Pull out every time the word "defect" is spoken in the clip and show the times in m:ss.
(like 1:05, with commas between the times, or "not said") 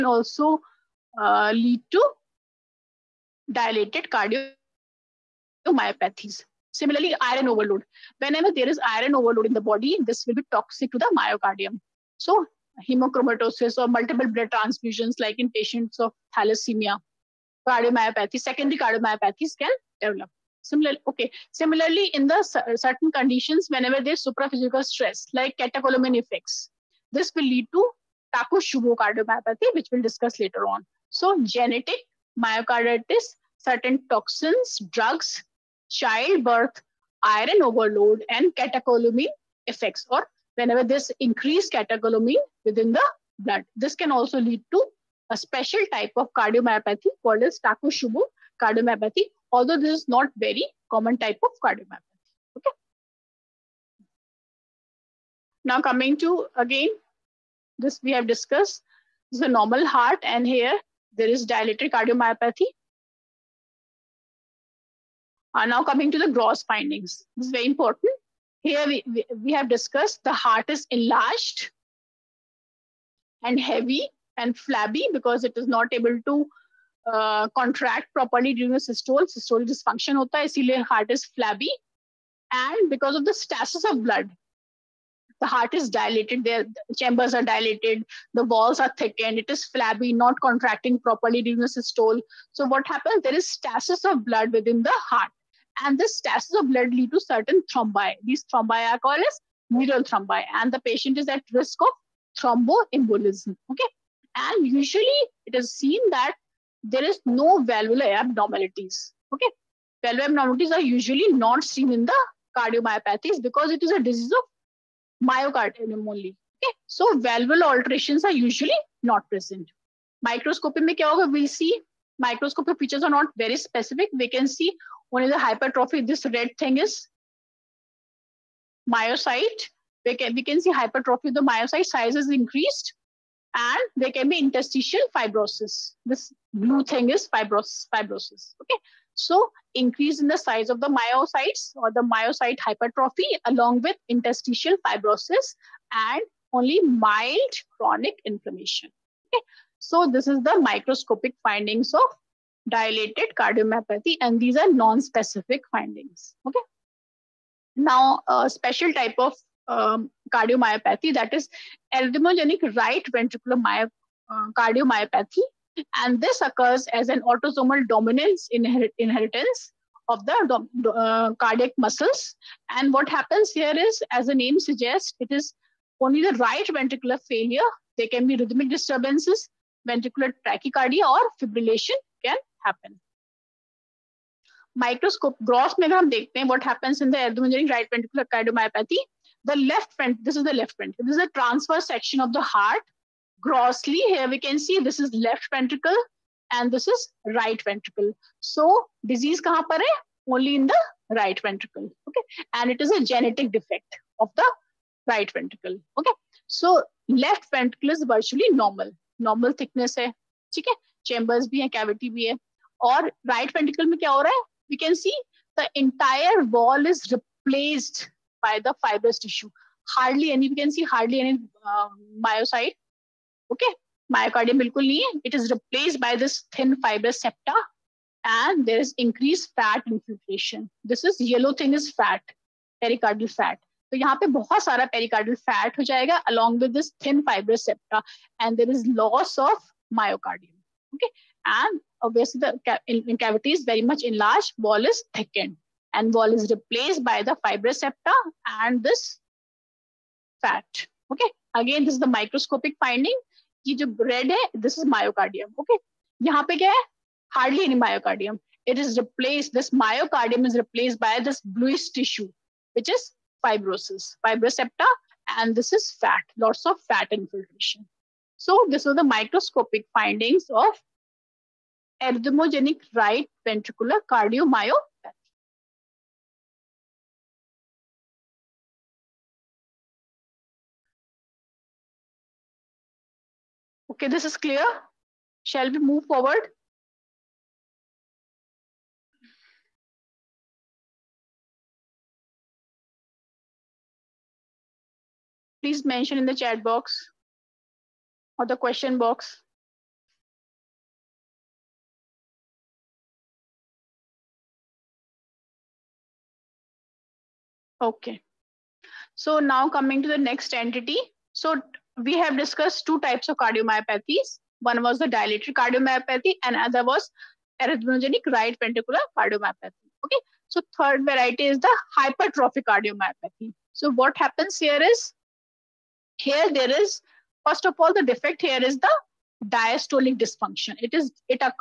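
3:23, 5:28.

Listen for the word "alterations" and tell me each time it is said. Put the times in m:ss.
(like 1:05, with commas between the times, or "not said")
1:57.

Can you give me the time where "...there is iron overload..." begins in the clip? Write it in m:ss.
0:08.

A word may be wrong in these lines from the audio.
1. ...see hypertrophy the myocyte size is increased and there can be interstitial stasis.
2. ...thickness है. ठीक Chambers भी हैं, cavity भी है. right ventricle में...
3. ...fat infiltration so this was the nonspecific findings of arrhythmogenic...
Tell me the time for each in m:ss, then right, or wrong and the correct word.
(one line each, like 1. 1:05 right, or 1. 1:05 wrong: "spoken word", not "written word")
1. 2:10 wrong: "fibrosis", not "stasis"
2. 3:29 right
3. 4:26 wrong: "microscopic", not "nonspecific".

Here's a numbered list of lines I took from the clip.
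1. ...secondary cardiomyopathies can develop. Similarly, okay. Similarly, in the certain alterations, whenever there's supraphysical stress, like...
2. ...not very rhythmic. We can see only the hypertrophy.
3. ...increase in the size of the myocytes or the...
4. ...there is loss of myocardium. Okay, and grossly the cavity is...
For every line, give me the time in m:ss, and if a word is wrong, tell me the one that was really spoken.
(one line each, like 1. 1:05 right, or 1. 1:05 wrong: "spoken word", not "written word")
1. 0:18 wrong: "conditions", not "alterations"
2. 2:03 wrong: "specific", not "rhythmic"
3. 2:19 right
4. 3:58 wrong: "obviously", not "grossly".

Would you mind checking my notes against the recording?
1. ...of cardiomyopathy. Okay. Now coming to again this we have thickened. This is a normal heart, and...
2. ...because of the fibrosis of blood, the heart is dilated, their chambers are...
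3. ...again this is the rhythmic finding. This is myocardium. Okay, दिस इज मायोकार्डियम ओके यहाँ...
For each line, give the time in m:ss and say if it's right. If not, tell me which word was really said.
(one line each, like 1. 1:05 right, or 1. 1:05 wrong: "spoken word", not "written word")
1. 0:51 wrong: "discussed", not "thickened"
2. 1:22 wrong: "stasis", not "fibrosis"
3. 4:11 wrong: "microscopic", not "rhythmic".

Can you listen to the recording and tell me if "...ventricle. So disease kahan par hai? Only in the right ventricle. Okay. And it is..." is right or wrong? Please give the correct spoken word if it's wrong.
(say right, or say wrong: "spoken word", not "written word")
right.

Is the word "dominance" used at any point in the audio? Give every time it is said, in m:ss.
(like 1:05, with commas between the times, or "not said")
2:47.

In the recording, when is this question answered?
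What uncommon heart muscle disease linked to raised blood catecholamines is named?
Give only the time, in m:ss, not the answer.
0:47.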